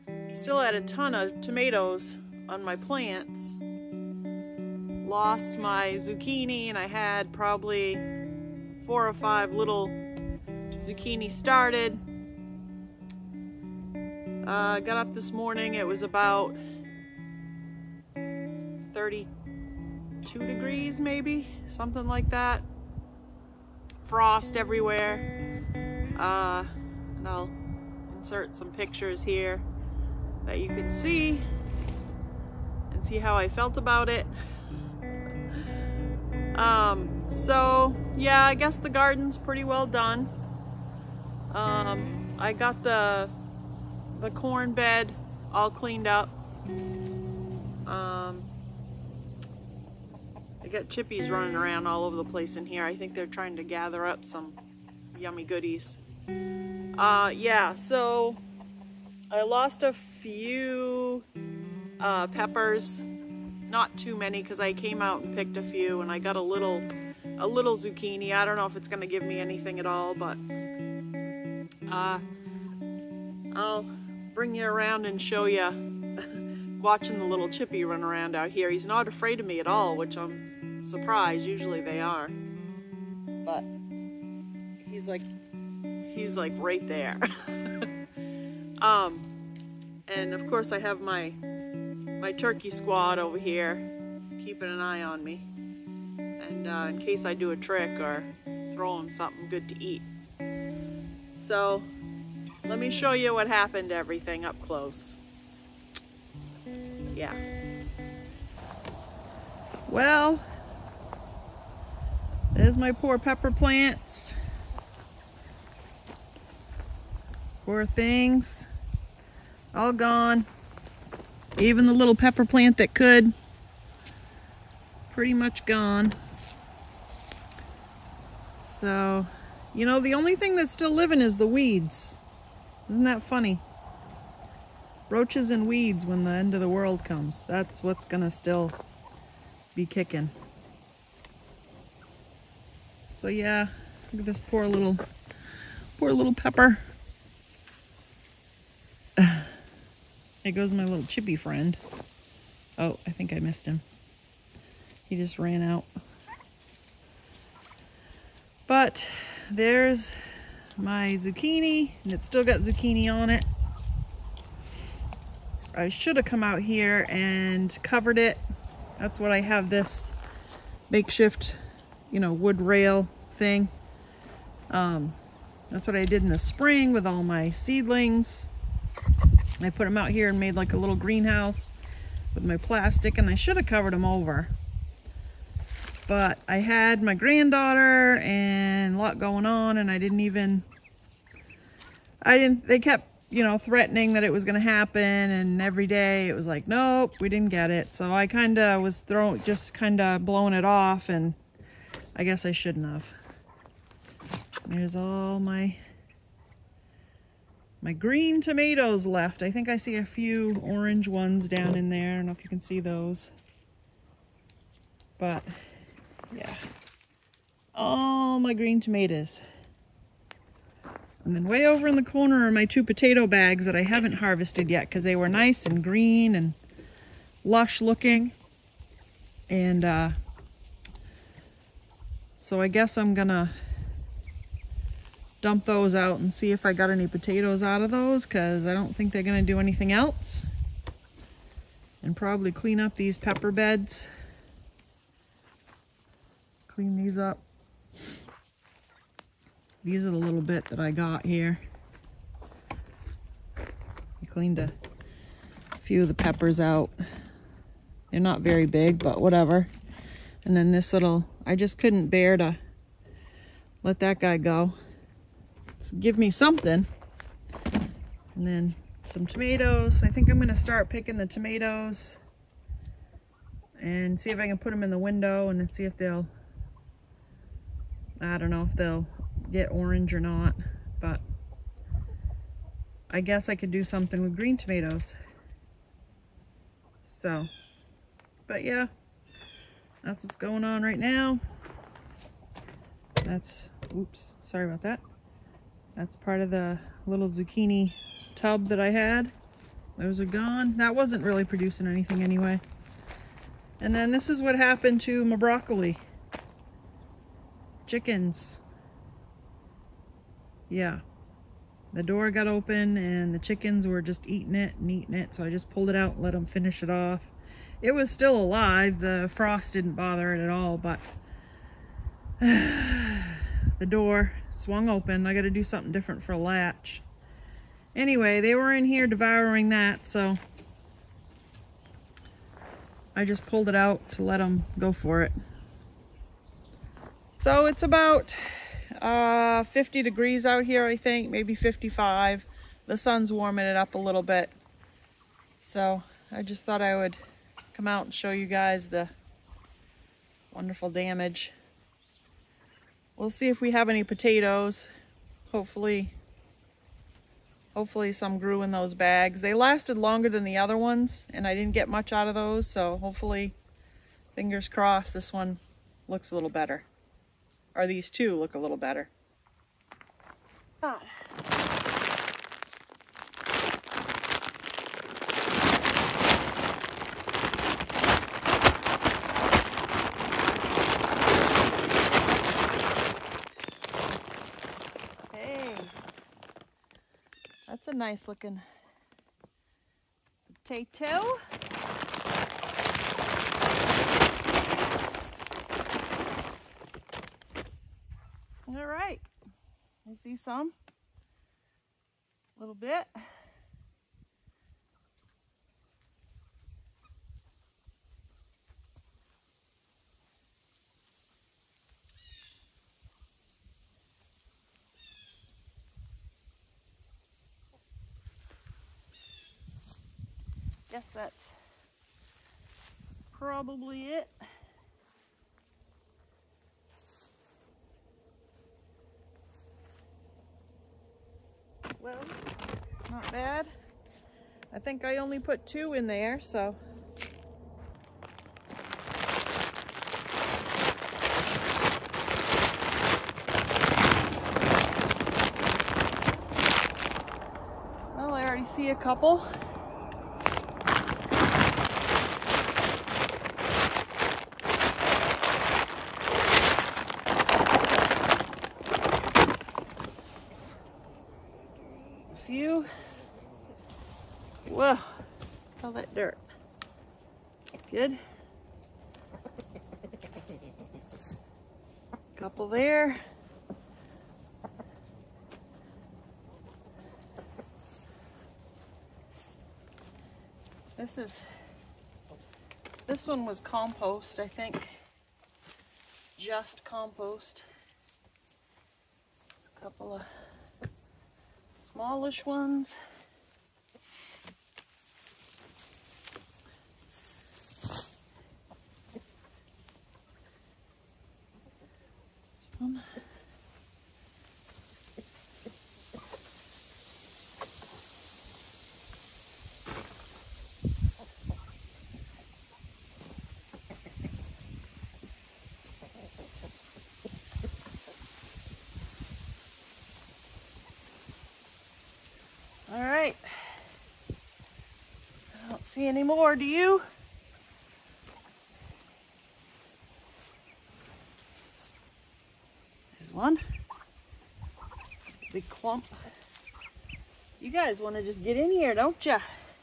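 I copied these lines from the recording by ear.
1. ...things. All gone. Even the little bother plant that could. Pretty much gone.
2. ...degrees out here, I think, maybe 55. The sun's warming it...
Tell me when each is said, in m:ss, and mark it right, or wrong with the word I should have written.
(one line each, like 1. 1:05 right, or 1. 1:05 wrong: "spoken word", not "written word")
1. 1:57 wrong: "pepper", not "bother"
2. 5:40 right.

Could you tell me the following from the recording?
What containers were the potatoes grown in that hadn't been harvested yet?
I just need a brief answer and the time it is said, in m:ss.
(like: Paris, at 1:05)
potato bags, at 3:42.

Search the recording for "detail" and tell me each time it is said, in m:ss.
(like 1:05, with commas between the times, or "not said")
not said.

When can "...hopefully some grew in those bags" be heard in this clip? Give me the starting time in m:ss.
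5:57.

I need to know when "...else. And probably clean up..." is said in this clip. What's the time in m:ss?
3:59.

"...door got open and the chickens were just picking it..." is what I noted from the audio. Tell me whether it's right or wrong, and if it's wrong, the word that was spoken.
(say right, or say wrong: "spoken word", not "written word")
wrong: "eating", not "picking".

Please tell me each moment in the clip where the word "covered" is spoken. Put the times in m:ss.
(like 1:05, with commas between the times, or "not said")
2:47, 3:03.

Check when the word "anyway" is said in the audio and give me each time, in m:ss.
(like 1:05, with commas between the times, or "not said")
5:02, 5:27.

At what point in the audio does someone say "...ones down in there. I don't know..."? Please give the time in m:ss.
3:31.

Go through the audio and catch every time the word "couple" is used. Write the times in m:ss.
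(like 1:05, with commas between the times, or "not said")
7:28, 7:52, 8:09.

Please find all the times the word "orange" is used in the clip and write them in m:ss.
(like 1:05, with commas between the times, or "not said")
3:30, 4:39.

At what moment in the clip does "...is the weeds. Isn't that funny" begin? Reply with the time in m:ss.
2:11.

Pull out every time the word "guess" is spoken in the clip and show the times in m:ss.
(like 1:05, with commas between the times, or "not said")
0:38, 3:22, 3:52, 4:43, 7:00.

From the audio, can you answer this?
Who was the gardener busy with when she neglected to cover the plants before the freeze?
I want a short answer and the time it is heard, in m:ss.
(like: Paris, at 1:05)
granddaughter, at 3:07.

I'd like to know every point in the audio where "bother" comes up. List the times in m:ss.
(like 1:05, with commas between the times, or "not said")
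5:19.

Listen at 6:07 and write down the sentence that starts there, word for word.
Or these two look a little better.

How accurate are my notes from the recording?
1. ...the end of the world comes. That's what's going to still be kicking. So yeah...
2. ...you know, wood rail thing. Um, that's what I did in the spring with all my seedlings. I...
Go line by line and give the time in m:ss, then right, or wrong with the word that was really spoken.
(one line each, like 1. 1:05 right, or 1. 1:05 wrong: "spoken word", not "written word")
1. 2:16 right
2. 2:52 right.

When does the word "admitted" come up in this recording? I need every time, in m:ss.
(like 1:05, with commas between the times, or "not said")
not said.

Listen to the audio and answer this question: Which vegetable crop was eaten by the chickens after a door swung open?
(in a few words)
broccoli.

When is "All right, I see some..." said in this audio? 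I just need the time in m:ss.
6:38.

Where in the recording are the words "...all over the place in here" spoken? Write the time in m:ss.
0:51.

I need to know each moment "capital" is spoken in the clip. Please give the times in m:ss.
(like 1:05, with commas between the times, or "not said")
not said.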